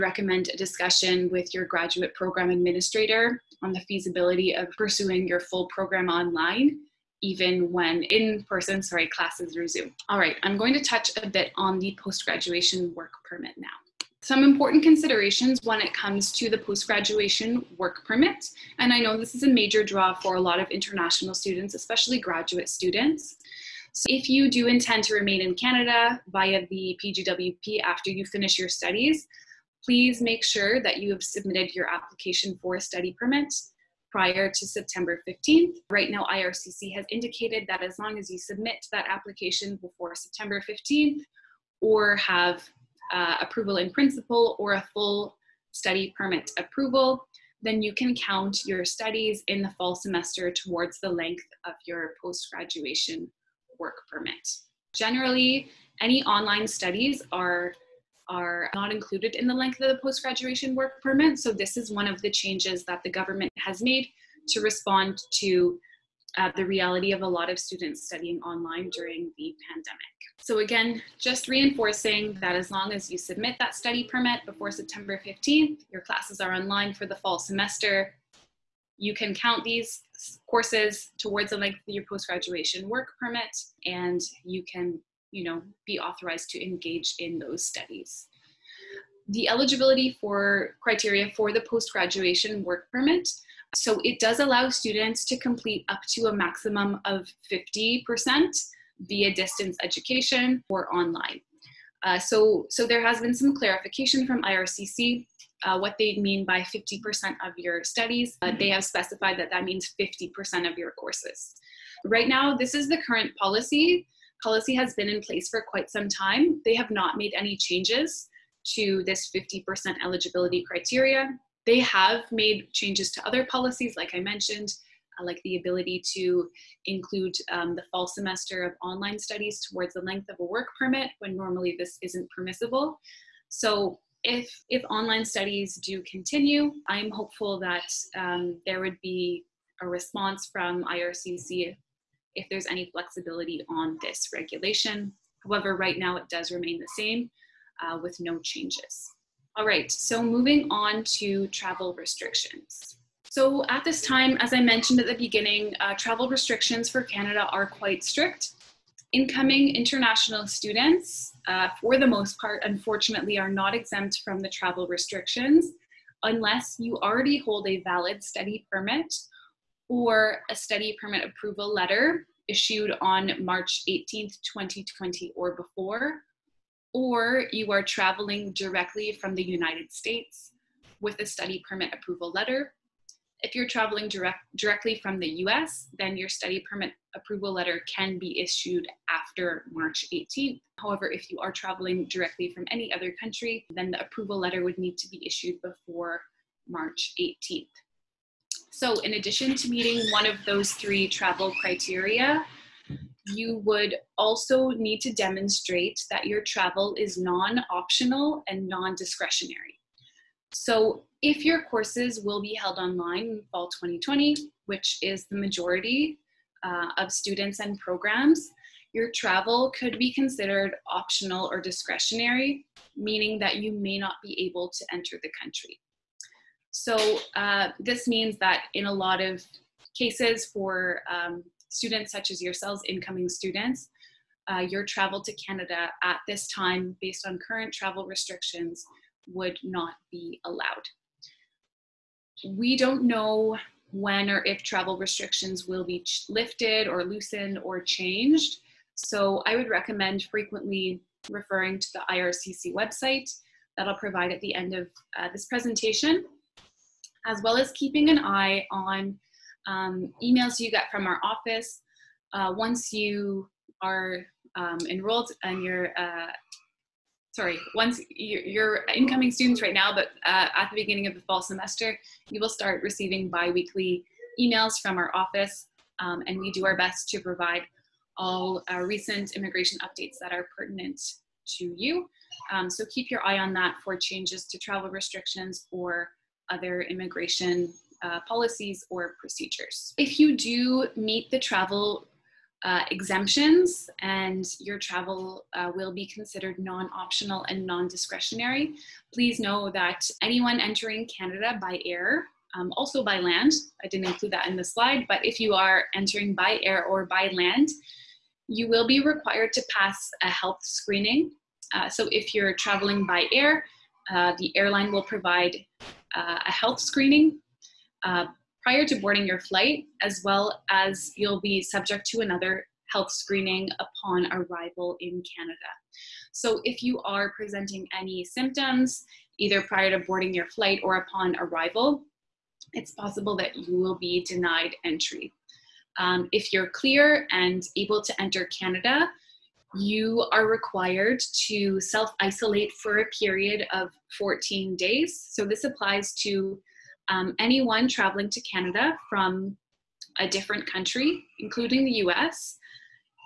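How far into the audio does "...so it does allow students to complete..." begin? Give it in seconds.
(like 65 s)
93 s.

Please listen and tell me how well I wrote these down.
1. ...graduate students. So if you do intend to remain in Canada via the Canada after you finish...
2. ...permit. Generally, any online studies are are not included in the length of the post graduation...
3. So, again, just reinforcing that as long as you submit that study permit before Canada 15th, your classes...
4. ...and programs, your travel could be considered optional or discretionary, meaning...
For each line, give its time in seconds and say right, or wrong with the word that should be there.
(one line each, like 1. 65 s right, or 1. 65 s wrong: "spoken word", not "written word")
1. 22 s wrong: "PGWP", not "Canada"
2. 54 s right
3. 70 s wrong: "September", not "Canada"
4. 217 s right.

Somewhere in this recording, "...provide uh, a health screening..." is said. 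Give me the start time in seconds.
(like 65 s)
315 s.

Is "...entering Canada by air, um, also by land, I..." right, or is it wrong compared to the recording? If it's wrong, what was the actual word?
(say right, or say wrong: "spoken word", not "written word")
right.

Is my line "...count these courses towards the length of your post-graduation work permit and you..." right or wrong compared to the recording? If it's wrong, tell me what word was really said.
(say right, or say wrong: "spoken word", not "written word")
right.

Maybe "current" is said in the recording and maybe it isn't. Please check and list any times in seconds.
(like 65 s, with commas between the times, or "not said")
113 s, 237 s.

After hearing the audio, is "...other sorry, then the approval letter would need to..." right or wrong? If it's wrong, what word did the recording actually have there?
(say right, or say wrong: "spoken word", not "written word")
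wrong: "country", not "sorry".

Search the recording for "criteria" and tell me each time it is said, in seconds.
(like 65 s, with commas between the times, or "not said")
90 s, 120 s, 201 s.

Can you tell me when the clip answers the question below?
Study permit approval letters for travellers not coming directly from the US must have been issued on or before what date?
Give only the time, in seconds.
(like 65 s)
173 s.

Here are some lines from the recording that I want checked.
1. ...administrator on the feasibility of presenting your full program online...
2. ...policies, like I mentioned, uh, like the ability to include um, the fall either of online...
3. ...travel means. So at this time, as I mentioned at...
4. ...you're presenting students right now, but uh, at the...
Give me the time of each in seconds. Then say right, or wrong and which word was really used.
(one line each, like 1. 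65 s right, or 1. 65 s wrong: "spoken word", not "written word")
1. 2 s wrong: "pursuing", not "presenting"
2. 123 s wrong: "semester", not "either"
3. 151 s wrong: "restrictions", not "means"
4. 268 s wrong: "incoming", not "presenting".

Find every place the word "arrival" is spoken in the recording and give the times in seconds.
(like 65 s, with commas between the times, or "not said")
324 s, 331 s.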